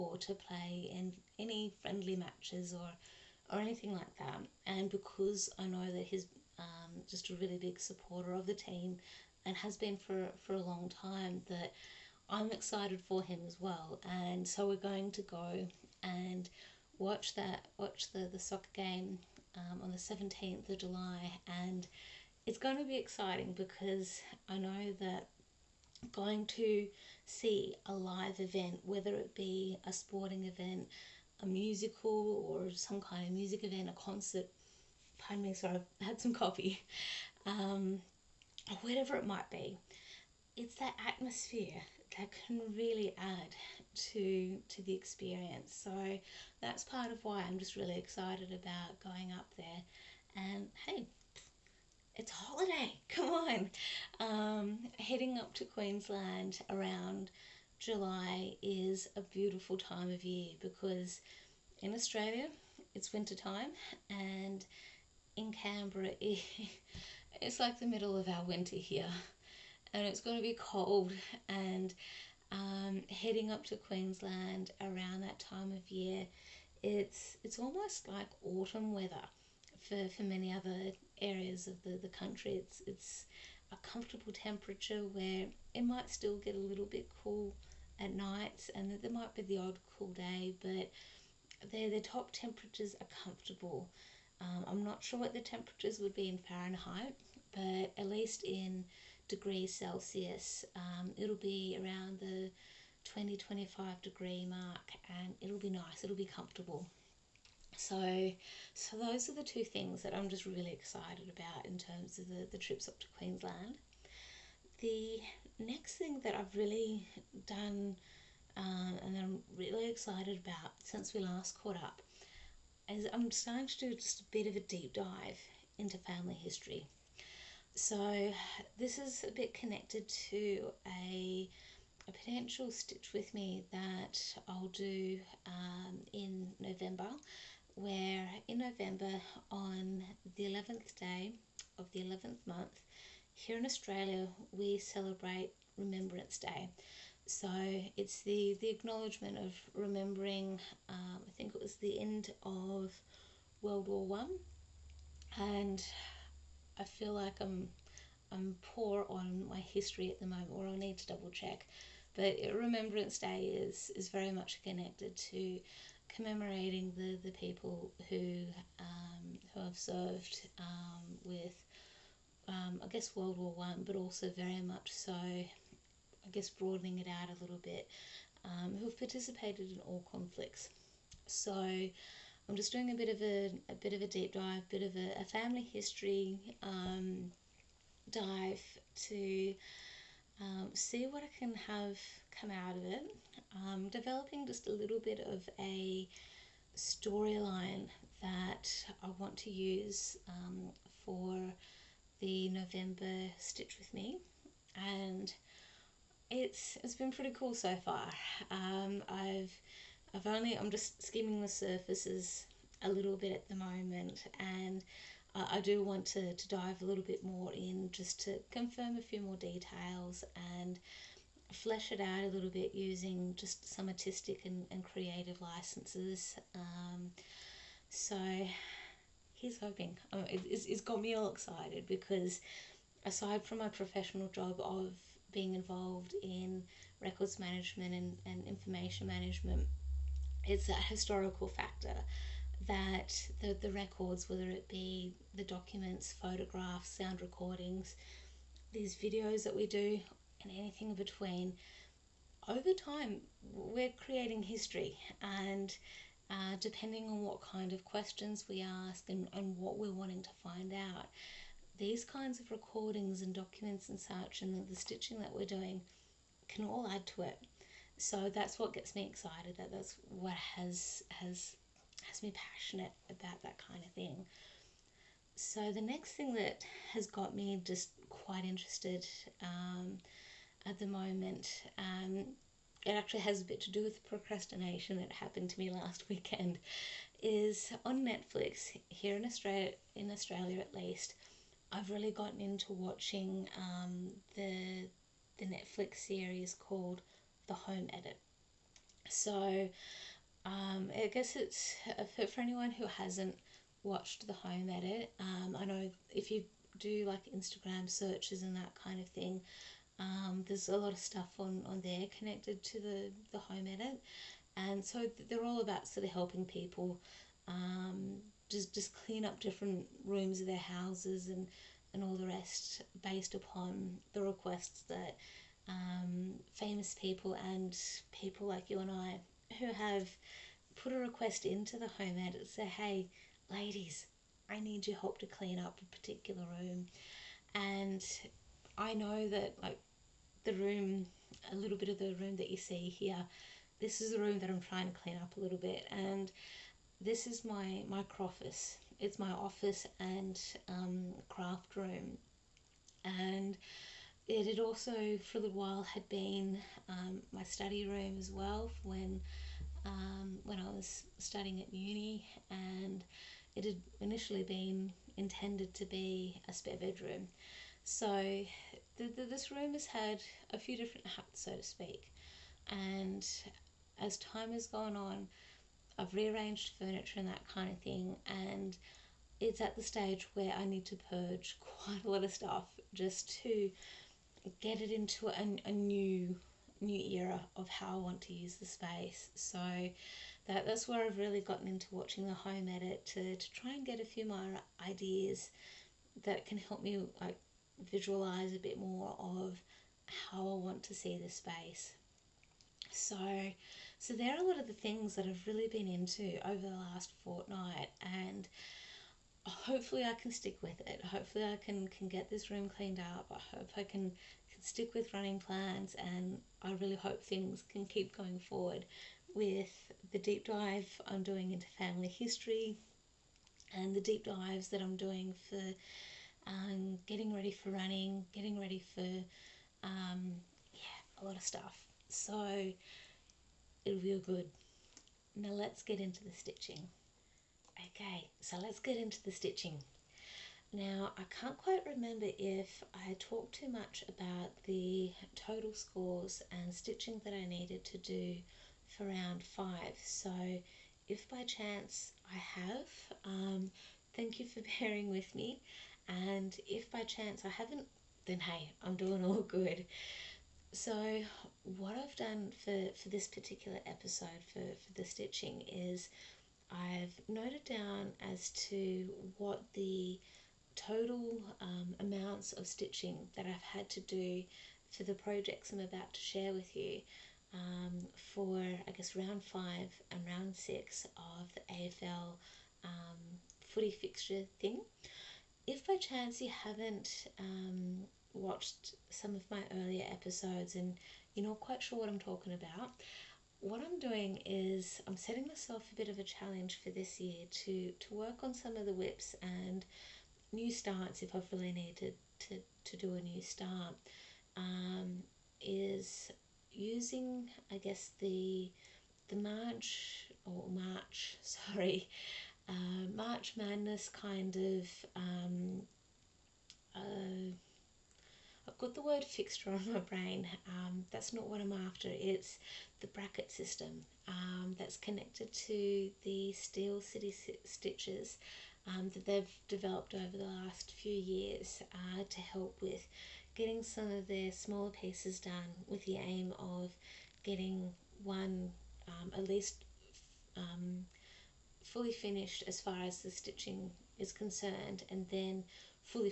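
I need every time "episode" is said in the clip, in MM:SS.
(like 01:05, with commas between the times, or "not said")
07:43, 08:10.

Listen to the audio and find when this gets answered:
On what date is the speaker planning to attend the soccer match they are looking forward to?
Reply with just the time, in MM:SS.
00:19.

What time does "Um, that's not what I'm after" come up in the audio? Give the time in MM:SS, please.
08:40.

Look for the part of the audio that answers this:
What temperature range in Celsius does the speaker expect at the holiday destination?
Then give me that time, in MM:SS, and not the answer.
01:43.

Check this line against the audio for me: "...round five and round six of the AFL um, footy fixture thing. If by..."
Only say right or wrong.
right.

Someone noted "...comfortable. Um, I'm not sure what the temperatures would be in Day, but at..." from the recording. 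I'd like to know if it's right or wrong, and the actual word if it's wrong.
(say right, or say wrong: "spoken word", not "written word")
wrong: "Fahrenheit", not "Day".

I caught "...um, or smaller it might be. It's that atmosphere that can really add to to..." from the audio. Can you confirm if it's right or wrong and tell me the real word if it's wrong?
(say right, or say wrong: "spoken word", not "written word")
wrong: "whatever", not "smaller".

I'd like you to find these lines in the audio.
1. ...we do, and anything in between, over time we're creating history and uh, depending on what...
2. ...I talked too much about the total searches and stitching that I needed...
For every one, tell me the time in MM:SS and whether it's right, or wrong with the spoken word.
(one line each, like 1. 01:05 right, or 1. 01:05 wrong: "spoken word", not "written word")
1. 04:09 right
2. 07:22 wrong: "scores", not "searches".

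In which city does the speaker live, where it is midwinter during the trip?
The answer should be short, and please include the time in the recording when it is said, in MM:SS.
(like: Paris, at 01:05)
Canberra, at 01:05.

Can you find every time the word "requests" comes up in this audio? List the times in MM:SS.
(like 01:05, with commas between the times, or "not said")
05:24, 05:30.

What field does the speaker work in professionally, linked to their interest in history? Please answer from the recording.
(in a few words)
Records management.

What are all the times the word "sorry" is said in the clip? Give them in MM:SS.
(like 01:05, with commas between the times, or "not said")
00:35, 08:31.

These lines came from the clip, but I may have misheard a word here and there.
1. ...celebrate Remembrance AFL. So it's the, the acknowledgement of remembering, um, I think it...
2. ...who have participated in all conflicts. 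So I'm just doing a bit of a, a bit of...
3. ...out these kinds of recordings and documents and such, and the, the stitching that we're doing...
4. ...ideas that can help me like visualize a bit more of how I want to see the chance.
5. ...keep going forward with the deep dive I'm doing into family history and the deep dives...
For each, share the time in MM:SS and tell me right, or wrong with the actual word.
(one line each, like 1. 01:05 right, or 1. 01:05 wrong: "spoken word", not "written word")
1. 02:24 wrong: "Day", not "AFL"
2. 02:58 right
3. 04:20 right
4. 06:34 wrong: "space", not "chance"
5. 06:57 right.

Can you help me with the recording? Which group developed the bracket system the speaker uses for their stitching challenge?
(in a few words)
Steel City Stitches.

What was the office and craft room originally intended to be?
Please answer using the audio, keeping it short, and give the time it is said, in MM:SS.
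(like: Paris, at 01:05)
A spare bedroom, at 06:06.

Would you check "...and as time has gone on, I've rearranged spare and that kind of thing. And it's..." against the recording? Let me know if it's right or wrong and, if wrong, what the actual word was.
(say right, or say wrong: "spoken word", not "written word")
wrong: "furniture", not "spare".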